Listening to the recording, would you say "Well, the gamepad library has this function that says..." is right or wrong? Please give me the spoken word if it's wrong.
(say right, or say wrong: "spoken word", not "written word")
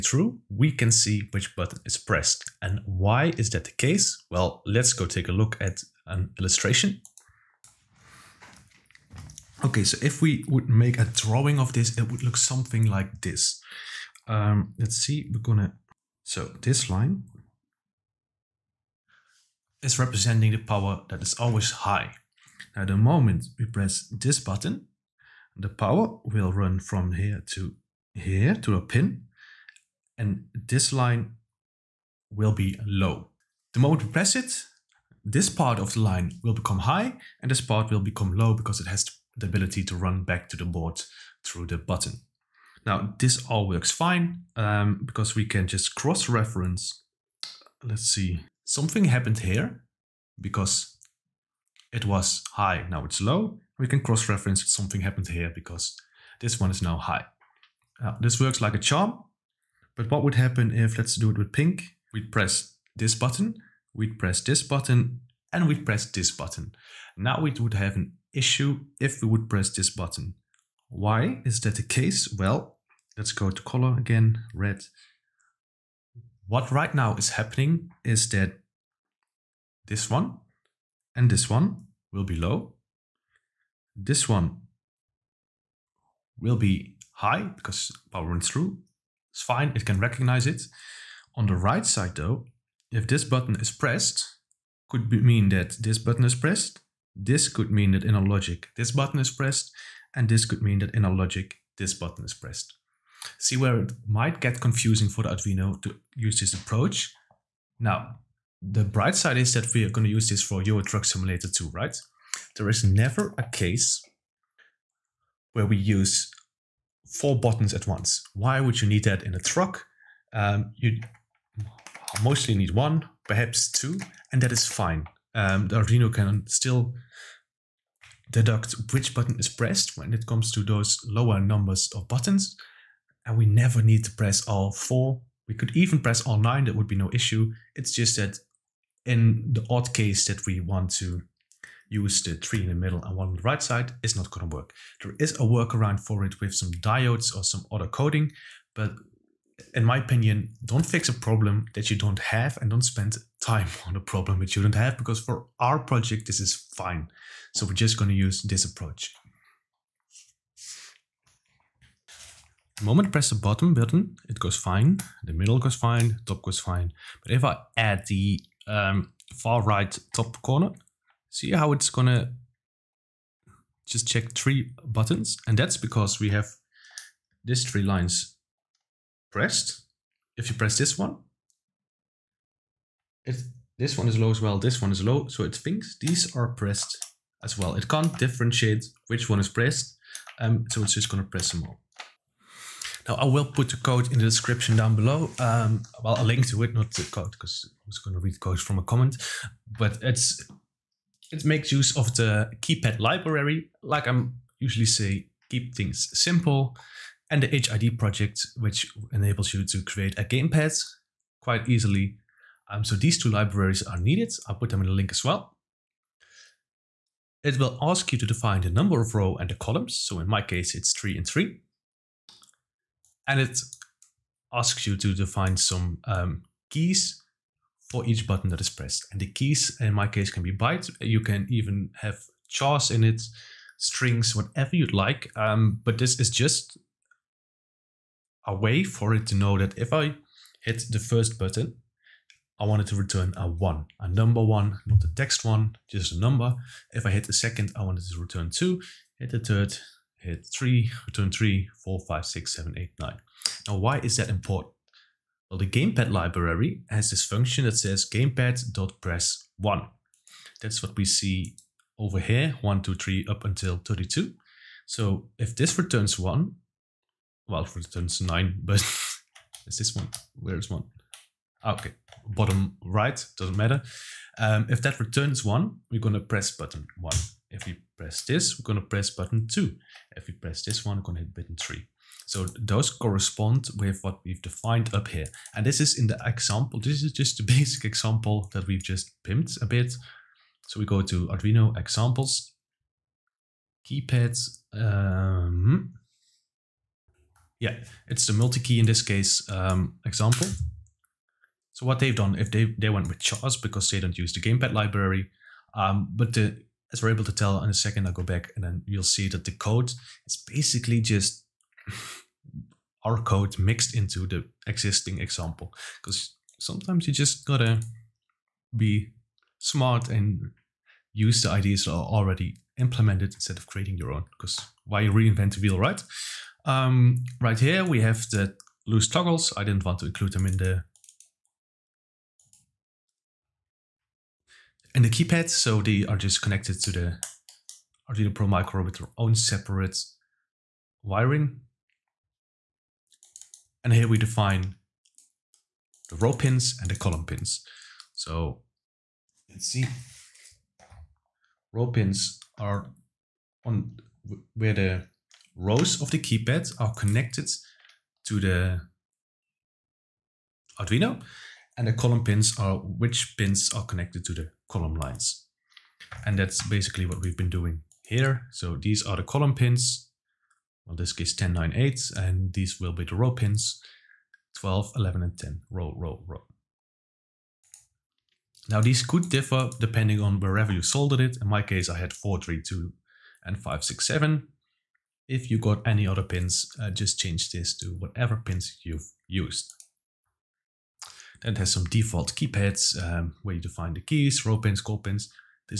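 right.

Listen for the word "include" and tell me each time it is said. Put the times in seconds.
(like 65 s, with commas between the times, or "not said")
330 s.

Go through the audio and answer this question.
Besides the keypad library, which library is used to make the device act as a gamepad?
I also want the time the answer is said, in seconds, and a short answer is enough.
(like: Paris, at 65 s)
HID project, at 207 s.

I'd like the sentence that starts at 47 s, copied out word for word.
Let's see, something happened here because it was high, now it's low.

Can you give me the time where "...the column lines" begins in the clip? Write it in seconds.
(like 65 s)
364 s.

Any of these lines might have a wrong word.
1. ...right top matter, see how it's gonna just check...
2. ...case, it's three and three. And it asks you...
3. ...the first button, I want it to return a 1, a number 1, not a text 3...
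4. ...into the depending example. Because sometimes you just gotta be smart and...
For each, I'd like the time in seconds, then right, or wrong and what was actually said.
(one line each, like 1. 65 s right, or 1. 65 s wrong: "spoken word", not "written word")
1. 169 s wrong: "corner", not "matter"
2. 220 s right
3. 240 s wrong: "1", not "3"
4. 313 s wrong: "existing", not "depending".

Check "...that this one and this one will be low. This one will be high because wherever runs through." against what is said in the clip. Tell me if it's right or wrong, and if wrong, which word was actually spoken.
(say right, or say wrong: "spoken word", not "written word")
wrong: "power", not "wherever".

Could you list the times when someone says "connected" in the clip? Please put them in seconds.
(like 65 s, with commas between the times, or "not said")
336 s, 356 s, 363 s.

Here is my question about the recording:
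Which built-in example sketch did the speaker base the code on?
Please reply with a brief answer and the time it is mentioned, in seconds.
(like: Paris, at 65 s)
multi-key, at 298 s.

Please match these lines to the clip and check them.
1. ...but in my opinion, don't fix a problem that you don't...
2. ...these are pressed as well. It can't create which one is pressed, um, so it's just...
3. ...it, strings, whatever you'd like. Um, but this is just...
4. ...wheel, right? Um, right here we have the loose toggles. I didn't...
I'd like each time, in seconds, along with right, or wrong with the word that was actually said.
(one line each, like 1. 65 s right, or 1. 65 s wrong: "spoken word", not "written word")
1. 148 s right
2. 186 s wrong: "differentiate", not "create"
3. 233 s right
4. 325 s right.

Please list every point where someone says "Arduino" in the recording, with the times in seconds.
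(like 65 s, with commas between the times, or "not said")
105 s, 125 s, 291 s, 338 s, 360 s.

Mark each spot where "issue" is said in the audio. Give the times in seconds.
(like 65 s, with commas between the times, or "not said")
68 s, 137 s.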